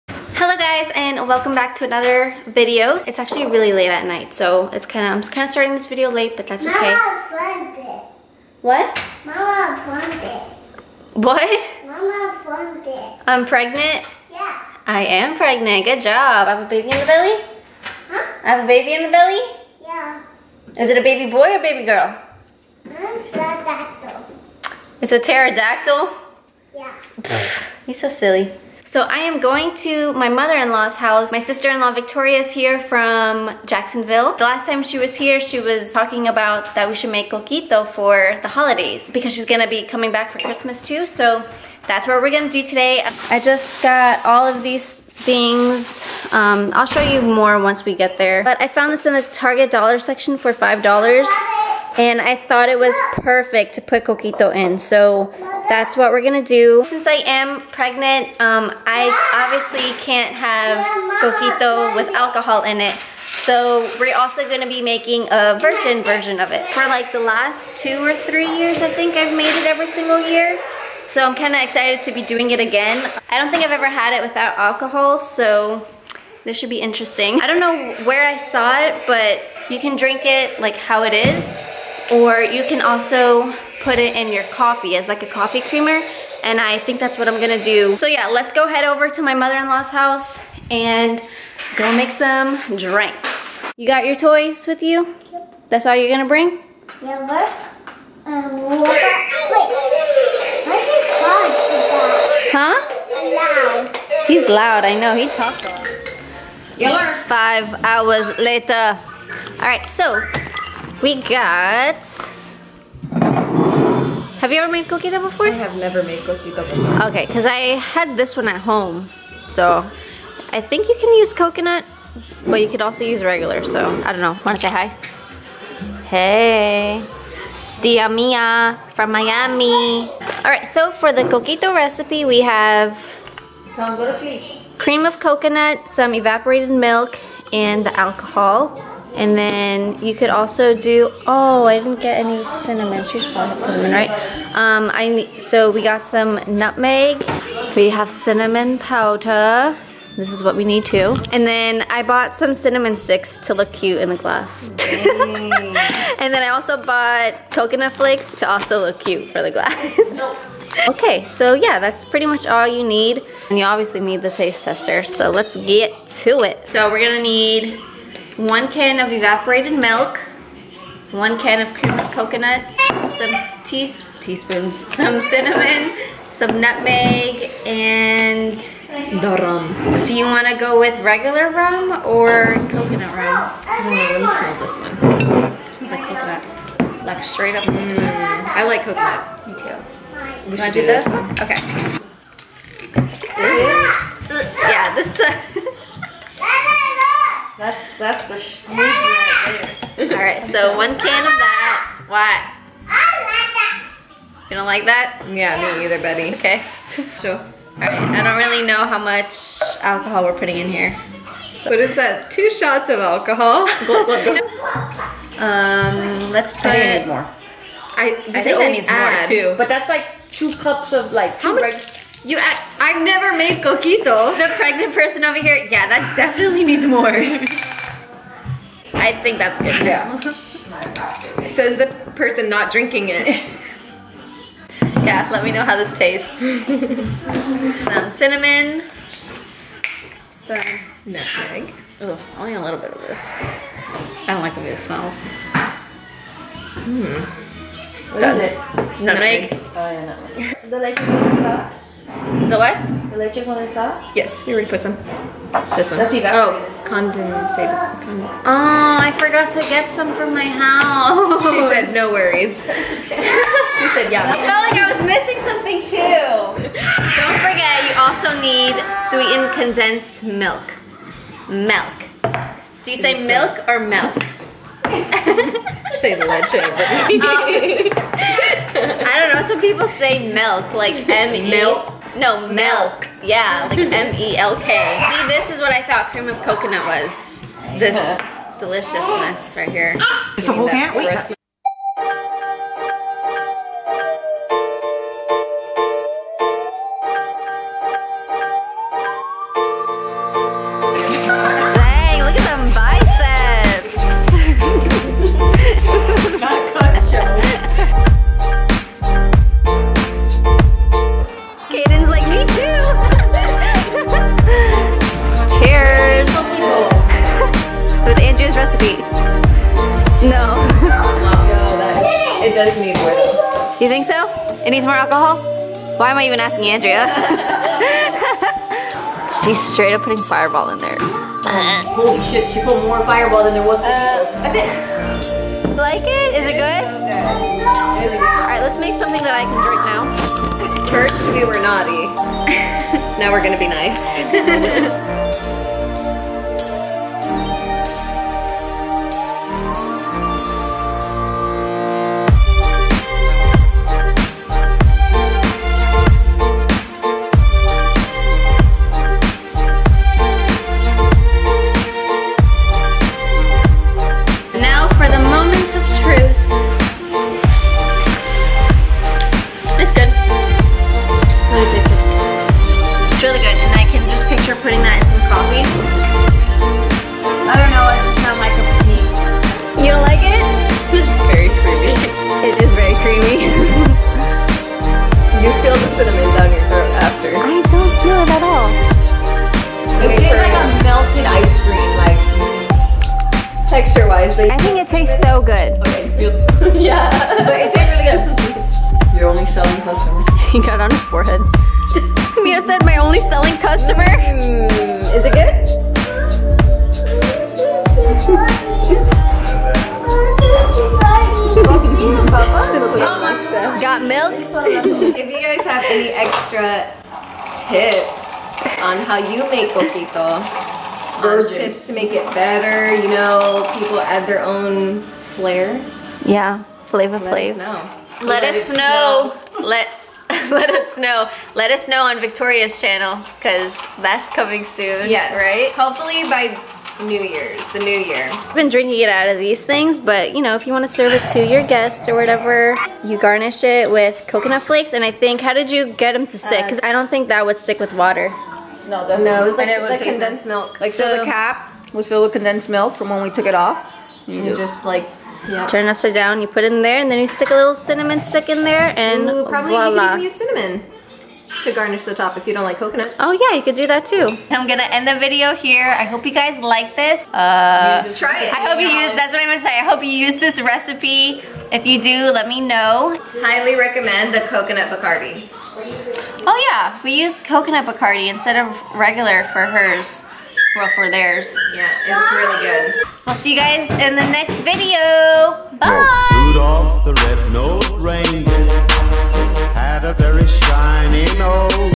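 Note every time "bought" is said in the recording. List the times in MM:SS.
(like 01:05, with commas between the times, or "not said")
02:32, 02:36.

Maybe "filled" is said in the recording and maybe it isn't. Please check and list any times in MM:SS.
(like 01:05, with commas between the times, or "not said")
07:32.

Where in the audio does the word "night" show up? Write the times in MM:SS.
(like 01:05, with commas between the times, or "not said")
00:04.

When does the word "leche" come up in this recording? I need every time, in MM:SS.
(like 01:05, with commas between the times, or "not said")
04:13, 04:36.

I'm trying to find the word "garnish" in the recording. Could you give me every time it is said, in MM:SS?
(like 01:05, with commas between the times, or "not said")
07:23, 07:41.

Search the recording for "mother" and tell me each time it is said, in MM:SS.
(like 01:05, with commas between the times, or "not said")
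00:30, 01:29.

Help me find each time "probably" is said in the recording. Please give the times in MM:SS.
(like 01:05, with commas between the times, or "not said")
02:23, 07:39.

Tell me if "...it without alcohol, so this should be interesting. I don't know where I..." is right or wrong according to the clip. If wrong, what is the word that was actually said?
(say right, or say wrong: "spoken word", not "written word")
right.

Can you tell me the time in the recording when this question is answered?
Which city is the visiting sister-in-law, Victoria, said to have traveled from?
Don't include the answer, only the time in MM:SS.
00:33.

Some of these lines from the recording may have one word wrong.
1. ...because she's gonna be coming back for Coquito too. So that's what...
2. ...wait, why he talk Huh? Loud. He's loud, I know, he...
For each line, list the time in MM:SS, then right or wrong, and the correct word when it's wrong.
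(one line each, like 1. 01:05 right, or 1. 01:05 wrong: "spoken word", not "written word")
1. 00:39 wrong: "Christmas", not "Coquito"
2. 01:38 right.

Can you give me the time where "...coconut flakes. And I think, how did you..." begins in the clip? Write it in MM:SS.
07:24.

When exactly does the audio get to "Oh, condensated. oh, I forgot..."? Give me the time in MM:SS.
04:16.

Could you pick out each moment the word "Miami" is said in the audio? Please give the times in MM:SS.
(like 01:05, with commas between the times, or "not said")
02:09.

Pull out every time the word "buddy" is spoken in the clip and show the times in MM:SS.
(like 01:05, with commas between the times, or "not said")
03:26.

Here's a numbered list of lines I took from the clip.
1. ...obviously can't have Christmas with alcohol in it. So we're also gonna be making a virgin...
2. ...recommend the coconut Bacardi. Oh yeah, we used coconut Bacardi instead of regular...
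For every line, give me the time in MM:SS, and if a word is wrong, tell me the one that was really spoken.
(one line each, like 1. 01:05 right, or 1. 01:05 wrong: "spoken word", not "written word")
1. 00:59 wrong: "Coquito", not "Christmas"
2. 07:53 right.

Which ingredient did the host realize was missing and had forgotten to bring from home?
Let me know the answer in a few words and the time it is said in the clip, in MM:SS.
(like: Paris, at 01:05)
Sweetened condensed milk, at 04:29.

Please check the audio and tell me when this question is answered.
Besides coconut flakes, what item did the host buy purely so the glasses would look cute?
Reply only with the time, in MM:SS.
02:32.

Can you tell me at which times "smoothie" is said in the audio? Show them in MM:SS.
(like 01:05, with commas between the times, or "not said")
03:18.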